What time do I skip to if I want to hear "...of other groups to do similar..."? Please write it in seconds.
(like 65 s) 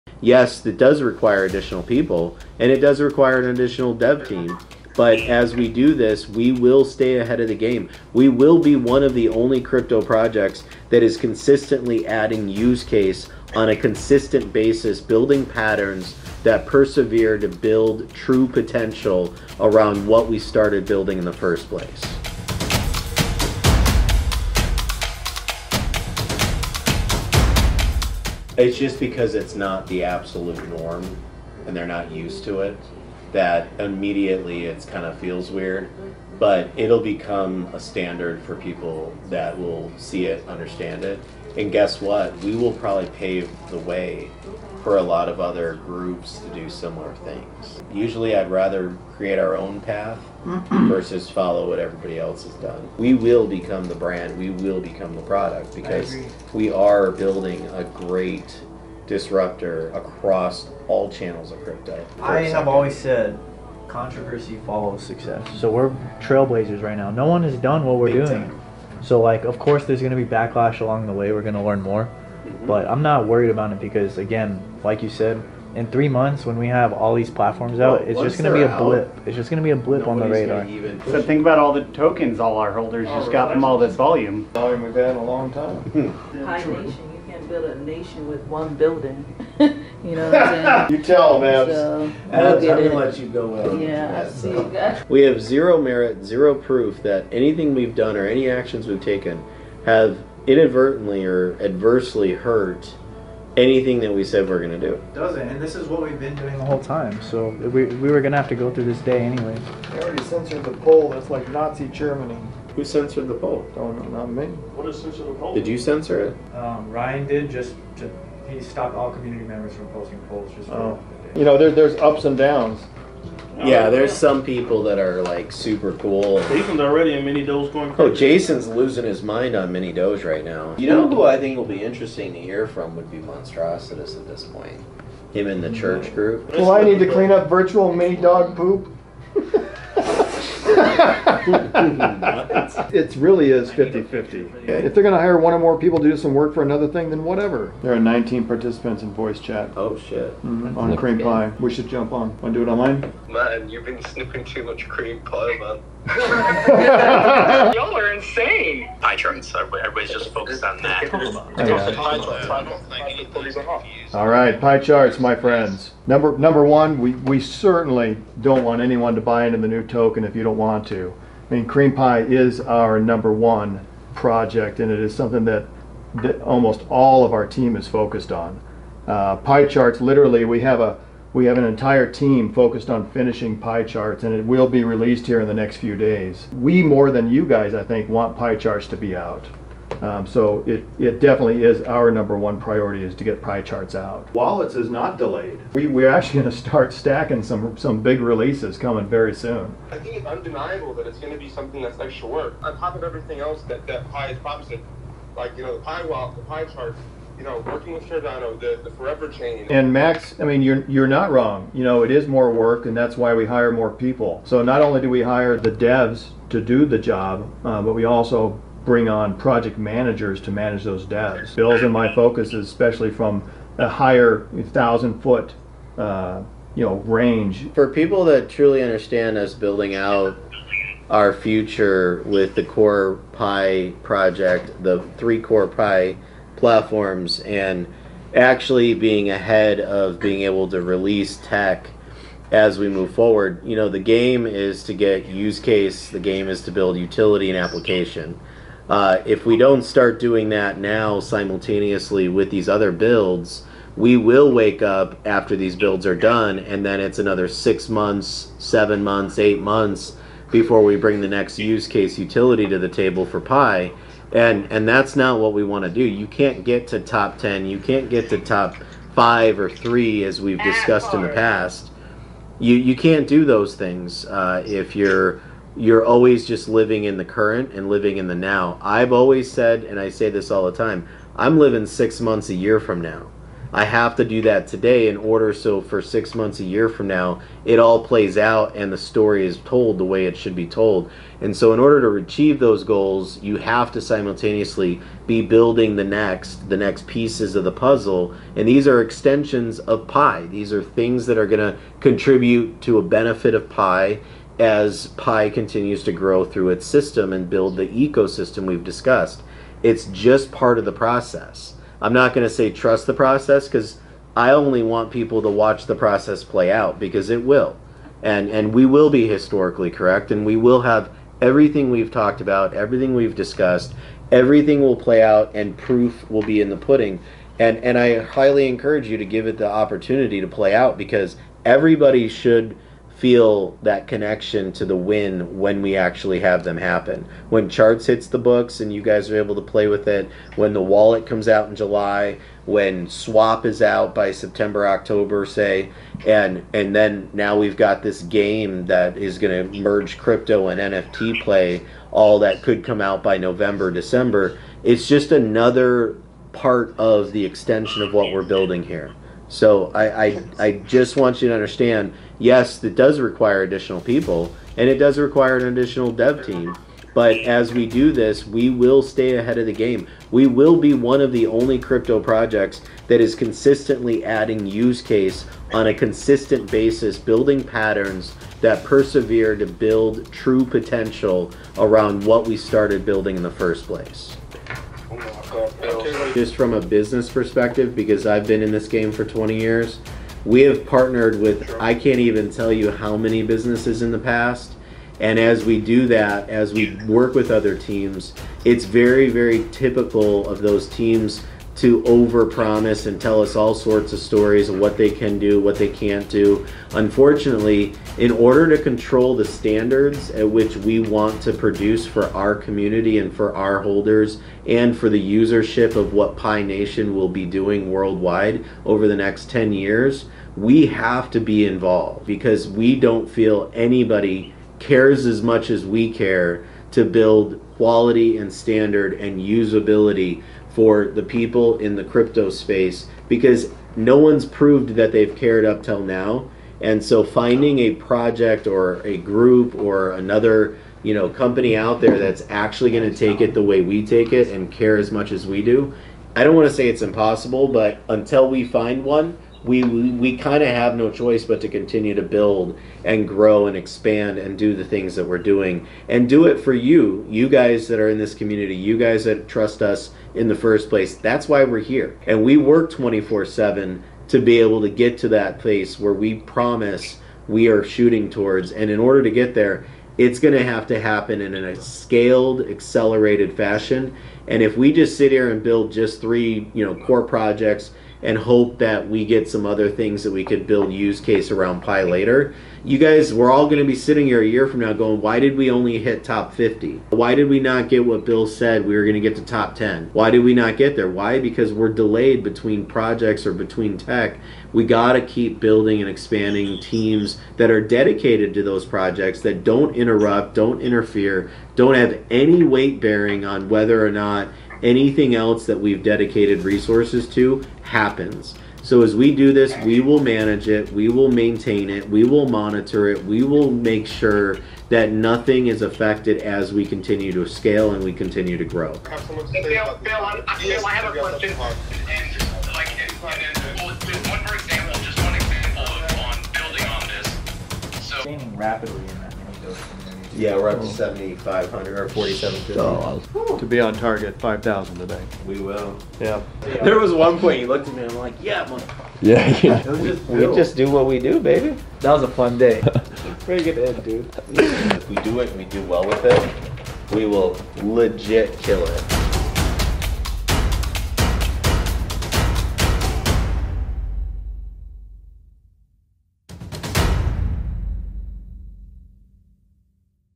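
45 s.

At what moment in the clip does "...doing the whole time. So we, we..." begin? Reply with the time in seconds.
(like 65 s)
106 s.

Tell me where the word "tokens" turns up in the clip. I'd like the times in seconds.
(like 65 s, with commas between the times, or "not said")
81 s, 169 s.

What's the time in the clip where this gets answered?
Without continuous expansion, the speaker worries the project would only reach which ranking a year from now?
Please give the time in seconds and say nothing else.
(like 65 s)
486 s.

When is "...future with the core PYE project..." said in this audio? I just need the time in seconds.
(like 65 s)
231 s.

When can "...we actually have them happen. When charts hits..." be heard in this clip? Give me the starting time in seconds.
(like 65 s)
335 s.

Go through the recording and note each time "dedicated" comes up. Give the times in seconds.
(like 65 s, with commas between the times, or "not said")
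497 s, 506 s.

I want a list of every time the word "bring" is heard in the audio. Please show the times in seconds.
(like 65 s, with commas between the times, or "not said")
218 s, 260 s.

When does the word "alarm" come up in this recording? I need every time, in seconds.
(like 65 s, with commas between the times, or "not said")
not said.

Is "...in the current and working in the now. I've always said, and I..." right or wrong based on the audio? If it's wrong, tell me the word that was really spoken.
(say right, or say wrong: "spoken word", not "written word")
wrong: "living", not "working".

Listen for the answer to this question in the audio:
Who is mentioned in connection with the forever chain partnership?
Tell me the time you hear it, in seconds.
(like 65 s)
208 s.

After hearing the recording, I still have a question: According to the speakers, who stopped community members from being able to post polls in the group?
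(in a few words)
Ryan.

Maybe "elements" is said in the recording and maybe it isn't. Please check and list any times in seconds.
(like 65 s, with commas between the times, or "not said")
not said.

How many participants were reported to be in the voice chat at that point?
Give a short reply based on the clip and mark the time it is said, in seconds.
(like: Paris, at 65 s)
19, at 147 s.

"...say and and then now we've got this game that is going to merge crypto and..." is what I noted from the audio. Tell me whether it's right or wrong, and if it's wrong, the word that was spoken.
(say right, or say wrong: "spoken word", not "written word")
right.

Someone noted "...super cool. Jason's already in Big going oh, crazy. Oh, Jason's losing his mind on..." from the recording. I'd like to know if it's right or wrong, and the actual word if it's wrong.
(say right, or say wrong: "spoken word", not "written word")
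wrong: "MiniDOGE", not "Big".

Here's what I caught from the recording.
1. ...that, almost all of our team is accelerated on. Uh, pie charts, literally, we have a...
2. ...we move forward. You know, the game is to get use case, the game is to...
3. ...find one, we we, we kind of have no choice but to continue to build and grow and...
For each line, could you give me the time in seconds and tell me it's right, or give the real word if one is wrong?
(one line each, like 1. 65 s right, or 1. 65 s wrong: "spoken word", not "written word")
1. 175 s wrong: "focused", not "accelerated"
2. 242 s right
3. 448 s right.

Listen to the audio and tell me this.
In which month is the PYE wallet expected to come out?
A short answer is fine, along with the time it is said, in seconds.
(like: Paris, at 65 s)
July, at 341 s.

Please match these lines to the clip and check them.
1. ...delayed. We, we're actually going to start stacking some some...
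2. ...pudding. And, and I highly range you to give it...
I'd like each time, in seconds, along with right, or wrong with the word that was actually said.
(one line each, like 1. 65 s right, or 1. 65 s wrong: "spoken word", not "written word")
1. 195 s right
2. 326 s wrong: "encourage", not "range".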